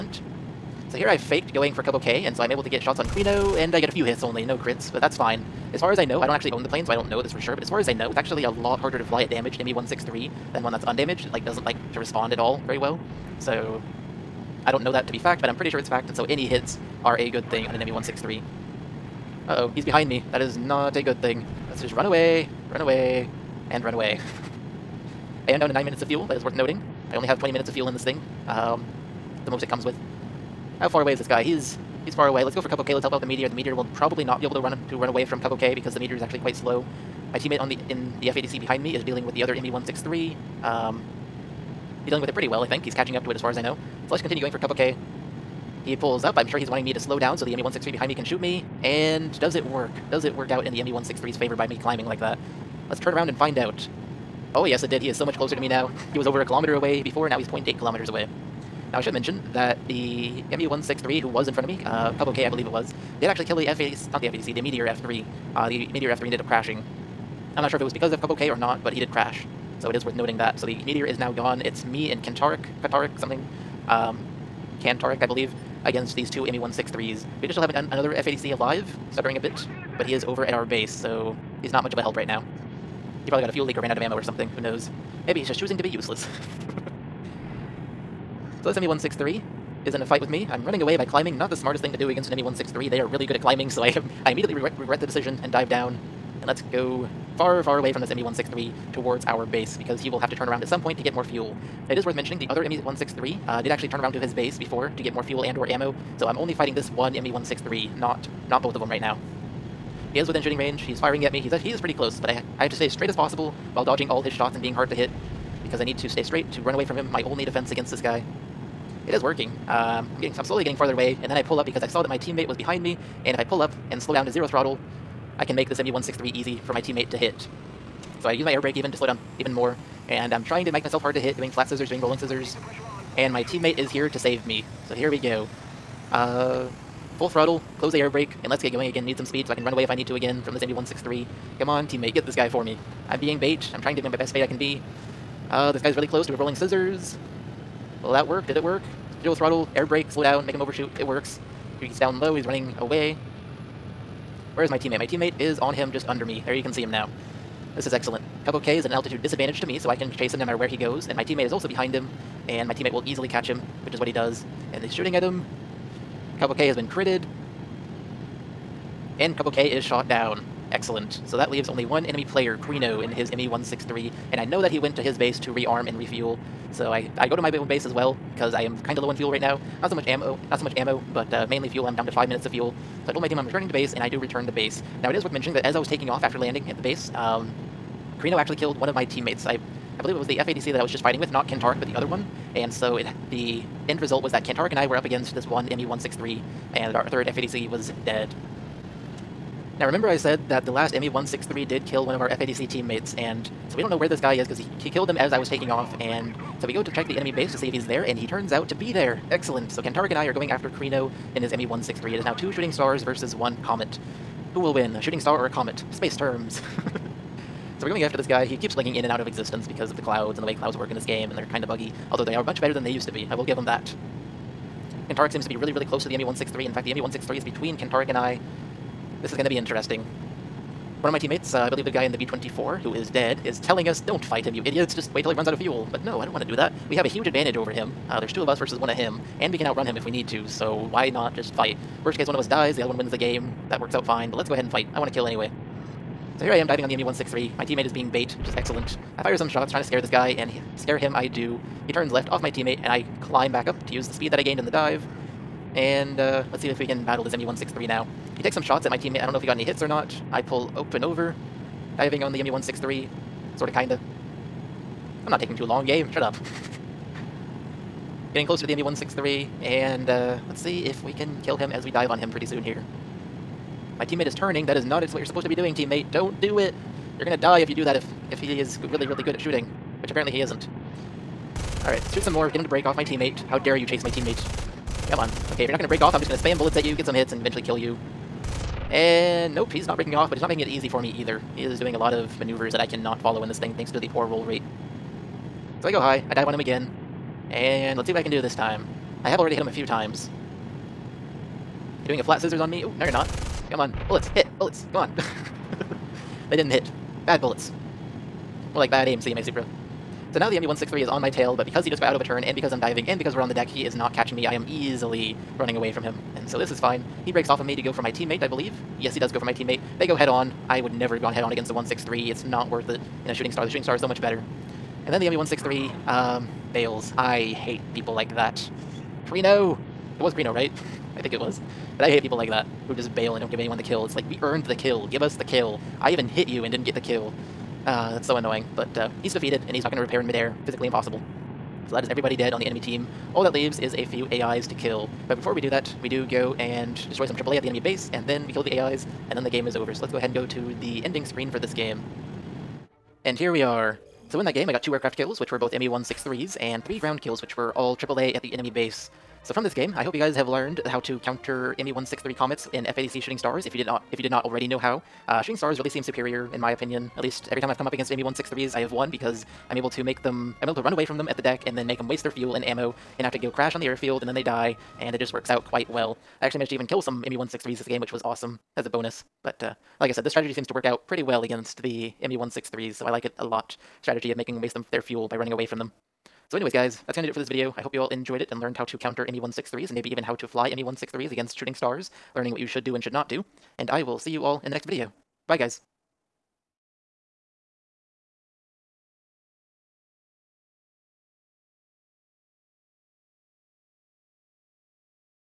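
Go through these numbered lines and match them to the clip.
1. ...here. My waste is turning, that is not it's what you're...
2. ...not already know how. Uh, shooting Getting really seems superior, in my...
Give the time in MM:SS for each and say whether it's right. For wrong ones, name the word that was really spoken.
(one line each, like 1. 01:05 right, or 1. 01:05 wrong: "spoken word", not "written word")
1. 04:32 wrong: "teammate", not "waste"
2. 06:04 wrong: "Stars", not "Getting".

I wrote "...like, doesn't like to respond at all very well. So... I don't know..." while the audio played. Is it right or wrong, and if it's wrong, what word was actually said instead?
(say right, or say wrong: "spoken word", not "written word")
right.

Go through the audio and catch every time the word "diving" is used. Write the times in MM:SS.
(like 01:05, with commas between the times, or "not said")
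04:06, 04:22, 05:12.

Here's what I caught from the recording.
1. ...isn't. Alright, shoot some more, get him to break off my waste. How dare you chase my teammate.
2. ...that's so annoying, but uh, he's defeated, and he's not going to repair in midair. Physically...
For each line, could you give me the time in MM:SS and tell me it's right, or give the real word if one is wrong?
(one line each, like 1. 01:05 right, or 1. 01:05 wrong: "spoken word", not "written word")
1. 04:40 wrong: "teammate", not "waste"
2. 05:38 right.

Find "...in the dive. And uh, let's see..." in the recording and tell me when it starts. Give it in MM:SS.
04:14.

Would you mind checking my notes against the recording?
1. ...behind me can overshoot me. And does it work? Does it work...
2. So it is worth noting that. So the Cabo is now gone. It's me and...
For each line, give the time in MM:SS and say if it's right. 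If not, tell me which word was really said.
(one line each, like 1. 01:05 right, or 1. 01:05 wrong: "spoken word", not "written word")
1. 00:47 wrong: "shoot", not "overshoot"
2. 01:09 wrong: "Meteor", not "Cabo".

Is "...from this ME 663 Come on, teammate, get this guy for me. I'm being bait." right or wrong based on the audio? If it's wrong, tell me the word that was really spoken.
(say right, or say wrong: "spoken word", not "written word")
wrong: "163", not "663".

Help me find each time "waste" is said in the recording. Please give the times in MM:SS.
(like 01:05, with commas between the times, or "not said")
06:12, 06:24.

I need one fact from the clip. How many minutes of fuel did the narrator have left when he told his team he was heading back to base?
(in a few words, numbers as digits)
5.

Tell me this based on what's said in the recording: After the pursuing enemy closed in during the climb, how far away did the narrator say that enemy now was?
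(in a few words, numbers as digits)
0.8 kilometers.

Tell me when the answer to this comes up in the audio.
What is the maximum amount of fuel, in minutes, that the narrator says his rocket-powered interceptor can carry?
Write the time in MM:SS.
00:27.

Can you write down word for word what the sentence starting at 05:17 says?
He breaks off of me to go for my teammate, I believe.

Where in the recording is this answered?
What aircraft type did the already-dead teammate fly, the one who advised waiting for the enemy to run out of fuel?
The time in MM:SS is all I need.
03:52.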